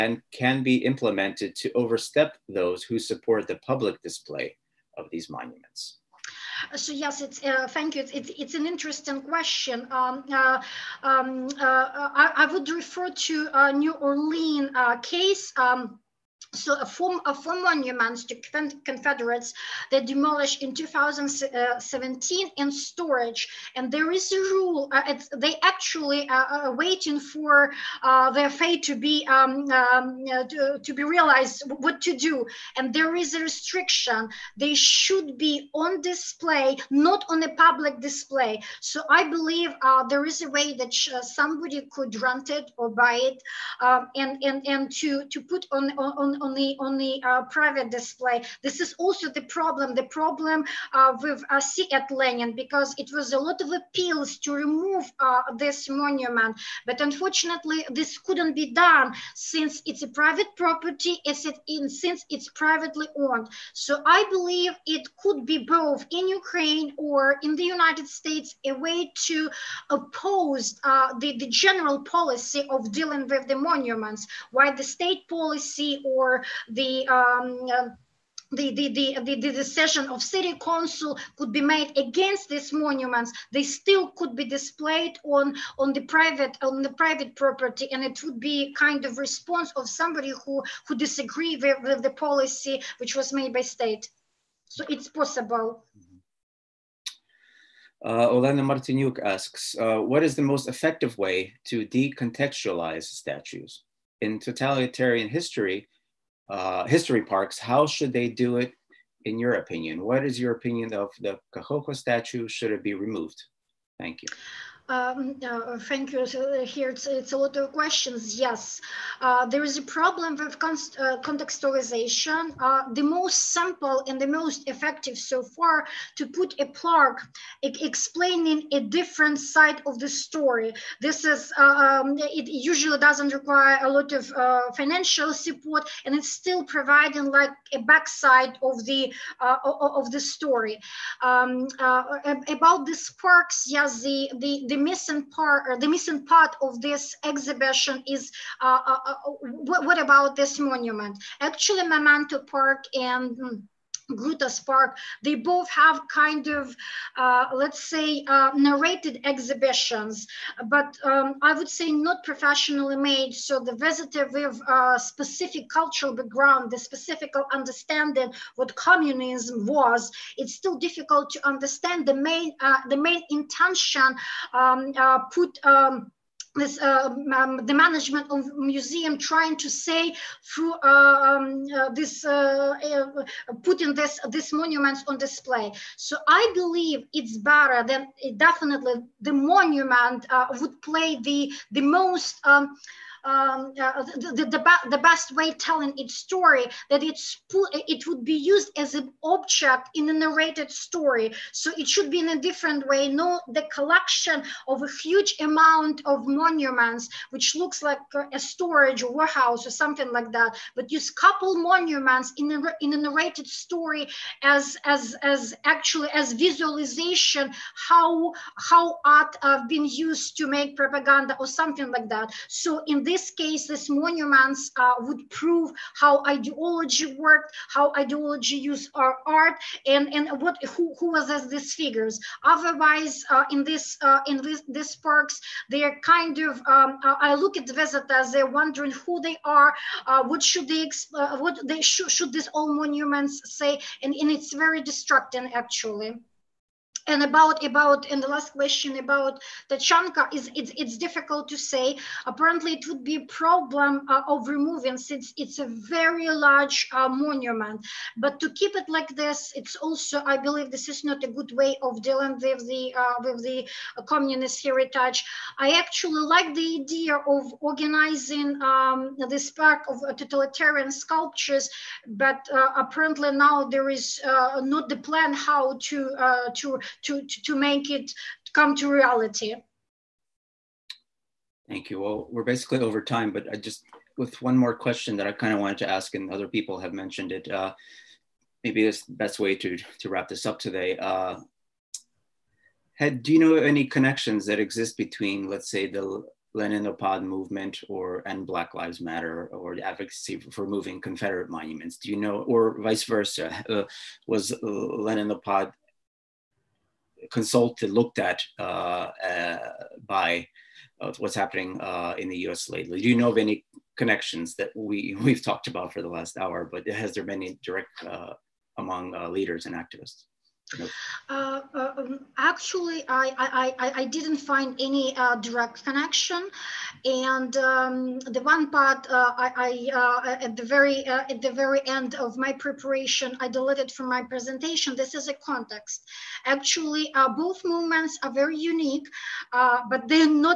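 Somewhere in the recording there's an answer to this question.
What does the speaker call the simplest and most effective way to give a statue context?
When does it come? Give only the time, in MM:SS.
02:06.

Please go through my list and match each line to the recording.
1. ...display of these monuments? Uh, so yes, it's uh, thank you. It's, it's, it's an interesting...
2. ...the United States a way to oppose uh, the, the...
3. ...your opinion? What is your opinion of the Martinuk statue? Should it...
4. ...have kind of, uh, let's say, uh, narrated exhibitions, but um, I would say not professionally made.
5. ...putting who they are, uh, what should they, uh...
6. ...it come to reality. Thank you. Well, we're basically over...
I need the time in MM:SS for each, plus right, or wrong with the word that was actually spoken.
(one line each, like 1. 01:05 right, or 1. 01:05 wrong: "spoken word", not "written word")
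1. 00:04 right
2. 01:07 right
3. 01:49 wrong: "Kakhovka", not "Martinuk"
4. 02:35 right
5. 03:58 wrong: "wondering", not "putting"
6. 04:37 right.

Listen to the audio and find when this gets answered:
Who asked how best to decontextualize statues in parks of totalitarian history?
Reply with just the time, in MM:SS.
01:38.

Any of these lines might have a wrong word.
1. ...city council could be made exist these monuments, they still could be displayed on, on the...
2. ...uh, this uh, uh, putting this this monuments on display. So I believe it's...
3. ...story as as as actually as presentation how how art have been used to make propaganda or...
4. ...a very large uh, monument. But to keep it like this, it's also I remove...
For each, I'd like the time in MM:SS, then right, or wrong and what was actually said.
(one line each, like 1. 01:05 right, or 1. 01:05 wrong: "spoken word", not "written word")
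1. 01:20 wrong: "against", not "exist"
2. 03:01 right
3. 03:33 wrong: "visualization", not "presentation"
4. 04:15 wrong: "believe", not "remove".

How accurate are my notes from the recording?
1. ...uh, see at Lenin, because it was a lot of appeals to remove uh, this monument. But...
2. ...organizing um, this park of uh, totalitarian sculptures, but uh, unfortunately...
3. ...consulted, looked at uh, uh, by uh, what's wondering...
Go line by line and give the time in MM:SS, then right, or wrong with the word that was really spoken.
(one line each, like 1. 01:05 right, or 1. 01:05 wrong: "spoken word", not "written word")
1. 00:51 right
2. 04:27 wrong: "apparently", not "unfortunately"
3. 05:07 wrong: "happening", not "wondering".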